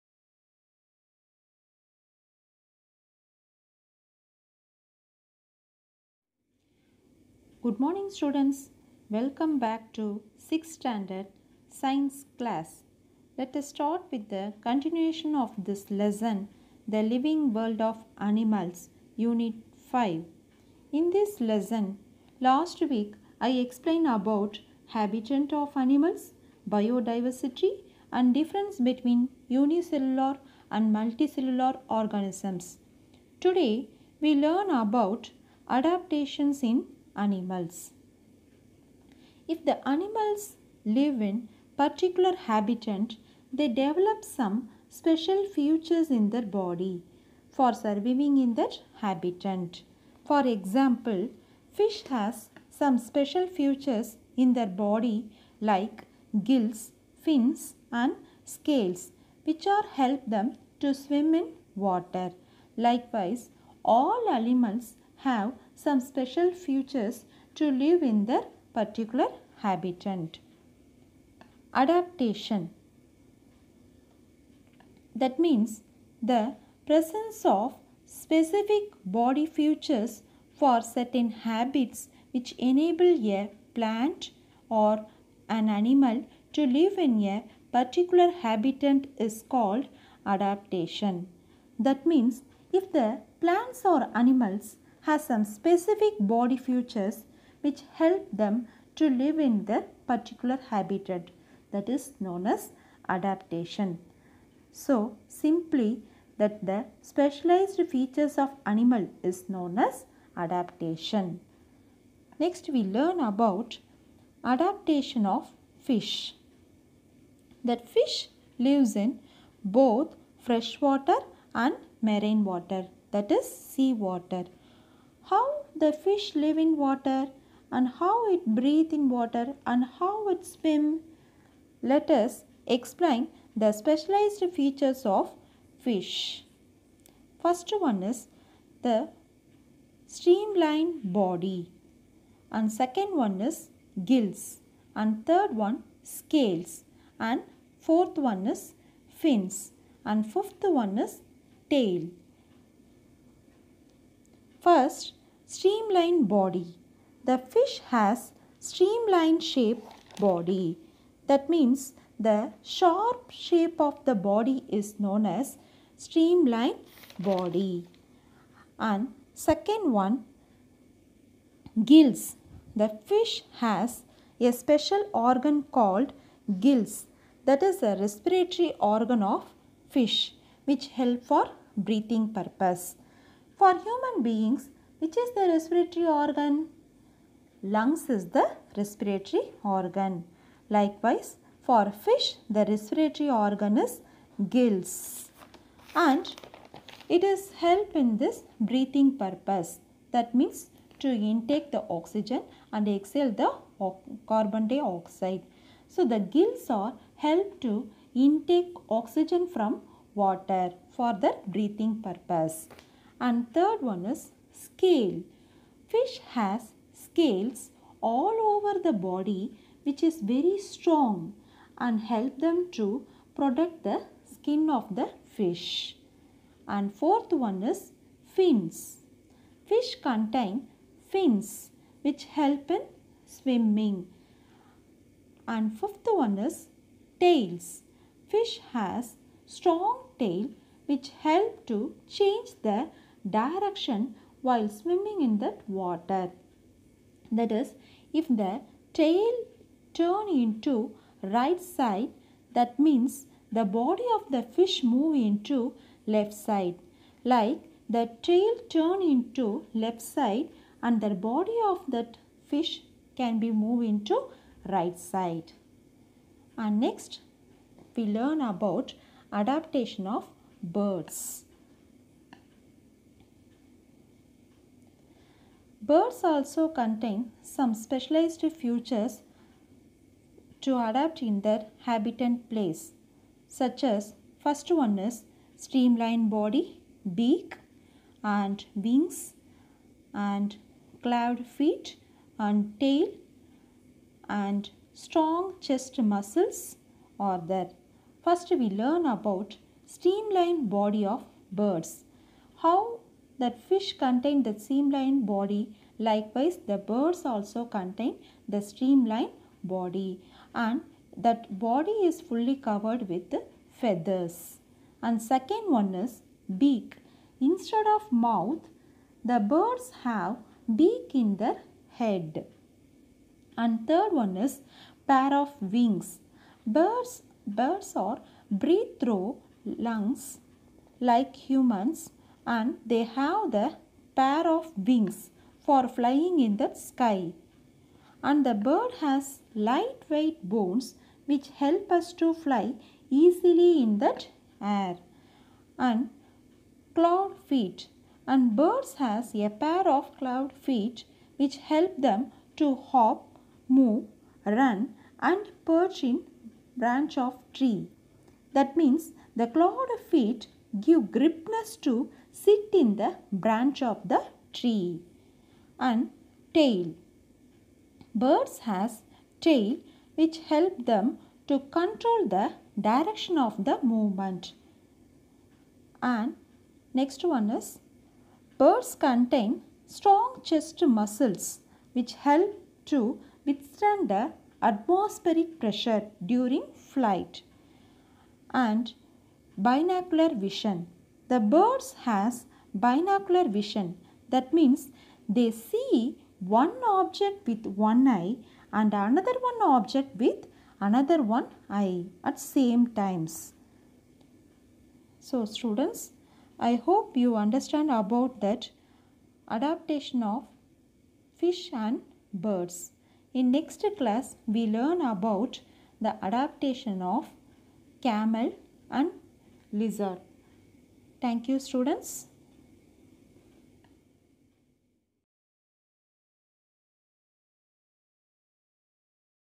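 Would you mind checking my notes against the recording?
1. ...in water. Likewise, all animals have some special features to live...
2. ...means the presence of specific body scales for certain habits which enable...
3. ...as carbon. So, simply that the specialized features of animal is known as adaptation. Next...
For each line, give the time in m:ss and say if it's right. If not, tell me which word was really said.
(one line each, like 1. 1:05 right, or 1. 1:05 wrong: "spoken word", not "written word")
1. 1:01 right
2. 1:15 wrong: "features", not "scales"
3. 1:42 wrong: "adaptation", not "carbon".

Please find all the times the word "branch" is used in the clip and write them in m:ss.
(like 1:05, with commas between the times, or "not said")
5:56, 6:03.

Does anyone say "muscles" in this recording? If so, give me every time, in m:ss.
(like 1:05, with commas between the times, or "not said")
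4:55, 6:20.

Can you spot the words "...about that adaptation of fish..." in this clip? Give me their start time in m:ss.
6:47.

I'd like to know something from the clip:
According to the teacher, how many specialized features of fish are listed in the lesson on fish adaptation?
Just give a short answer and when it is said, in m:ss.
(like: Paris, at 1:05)
5, at 2:30.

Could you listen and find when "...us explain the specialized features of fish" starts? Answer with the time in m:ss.
2:12.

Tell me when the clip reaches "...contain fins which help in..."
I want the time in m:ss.
3:50.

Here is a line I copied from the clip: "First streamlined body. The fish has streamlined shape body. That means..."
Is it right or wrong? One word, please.
right.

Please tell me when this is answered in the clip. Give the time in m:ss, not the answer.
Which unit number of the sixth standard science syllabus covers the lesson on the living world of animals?
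0:19.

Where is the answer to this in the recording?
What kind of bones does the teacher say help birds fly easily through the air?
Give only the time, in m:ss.
5:39.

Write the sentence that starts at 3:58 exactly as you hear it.
Fish has strong tail which help to change the direction while swimming in that water.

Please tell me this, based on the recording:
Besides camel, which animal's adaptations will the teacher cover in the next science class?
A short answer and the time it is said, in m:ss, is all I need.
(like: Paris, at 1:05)
Lizard, at 6:59.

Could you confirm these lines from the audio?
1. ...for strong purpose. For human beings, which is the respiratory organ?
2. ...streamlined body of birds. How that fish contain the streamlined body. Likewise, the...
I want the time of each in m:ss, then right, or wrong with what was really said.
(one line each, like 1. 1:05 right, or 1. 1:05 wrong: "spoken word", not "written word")
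1. 3:01 wrong: "breathing", not "strong"
2. 4:59 right.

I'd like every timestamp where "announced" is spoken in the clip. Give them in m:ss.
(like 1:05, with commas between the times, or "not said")
not said.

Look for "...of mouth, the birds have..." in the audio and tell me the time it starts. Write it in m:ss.
5:17.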